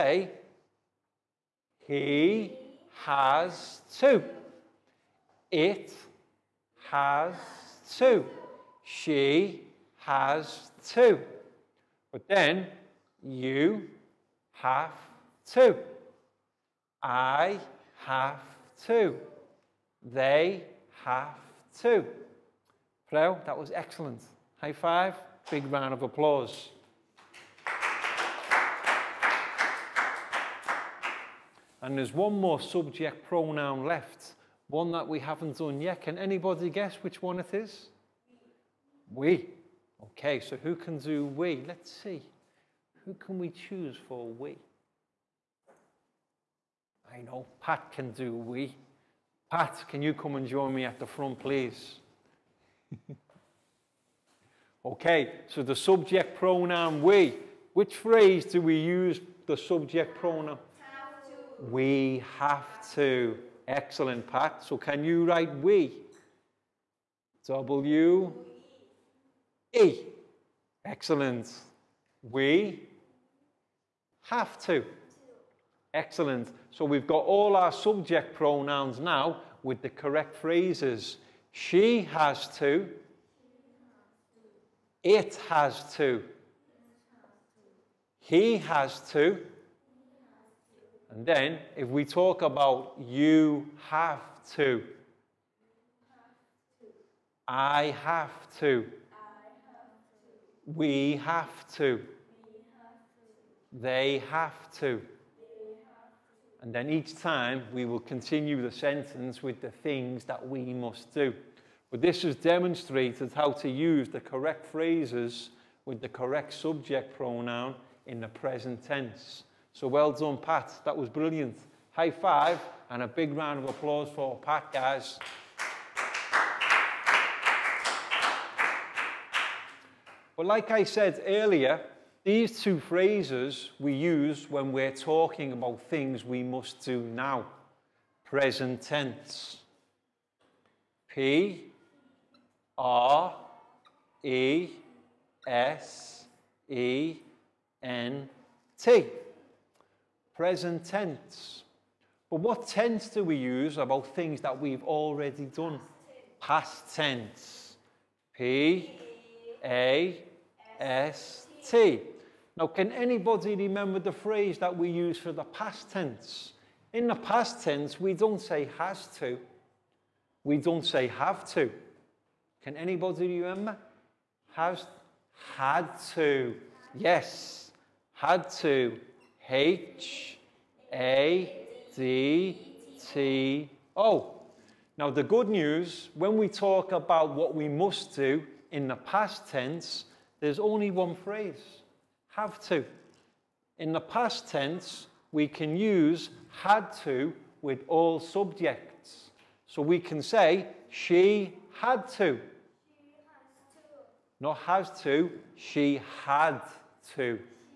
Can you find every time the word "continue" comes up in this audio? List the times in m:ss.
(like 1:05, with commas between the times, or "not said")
1:47.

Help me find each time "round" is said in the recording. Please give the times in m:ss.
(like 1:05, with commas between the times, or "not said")
0:25, 2:03.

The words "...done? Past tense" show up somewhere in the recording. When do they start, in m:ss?
2:35.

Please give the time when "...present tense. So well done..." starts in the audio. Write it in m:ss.
1:58.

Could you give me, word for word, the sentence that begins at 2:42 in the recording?
Now, can anybody remember the phrase that we use for the past tense?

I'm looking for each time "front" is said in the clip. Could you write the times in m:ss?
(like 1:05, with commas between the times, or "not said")
0:51.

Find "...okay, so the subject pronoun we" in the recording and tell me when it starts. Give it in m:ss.
0:54.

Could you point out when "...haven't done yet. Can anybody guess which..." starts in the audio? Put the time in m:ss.
0:35.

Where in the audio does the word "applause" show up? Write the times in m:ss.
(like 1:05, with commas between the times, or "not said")
0:26, 2:03.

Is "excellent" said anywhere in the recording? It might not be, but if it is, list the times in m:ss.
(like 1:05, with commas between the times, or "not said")
0:23, 1:03, 1:10, 1:15.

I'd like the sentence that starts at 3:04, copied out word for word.
Now, the good news when we talk about what we must do in the past tense, there's only one phrase have to.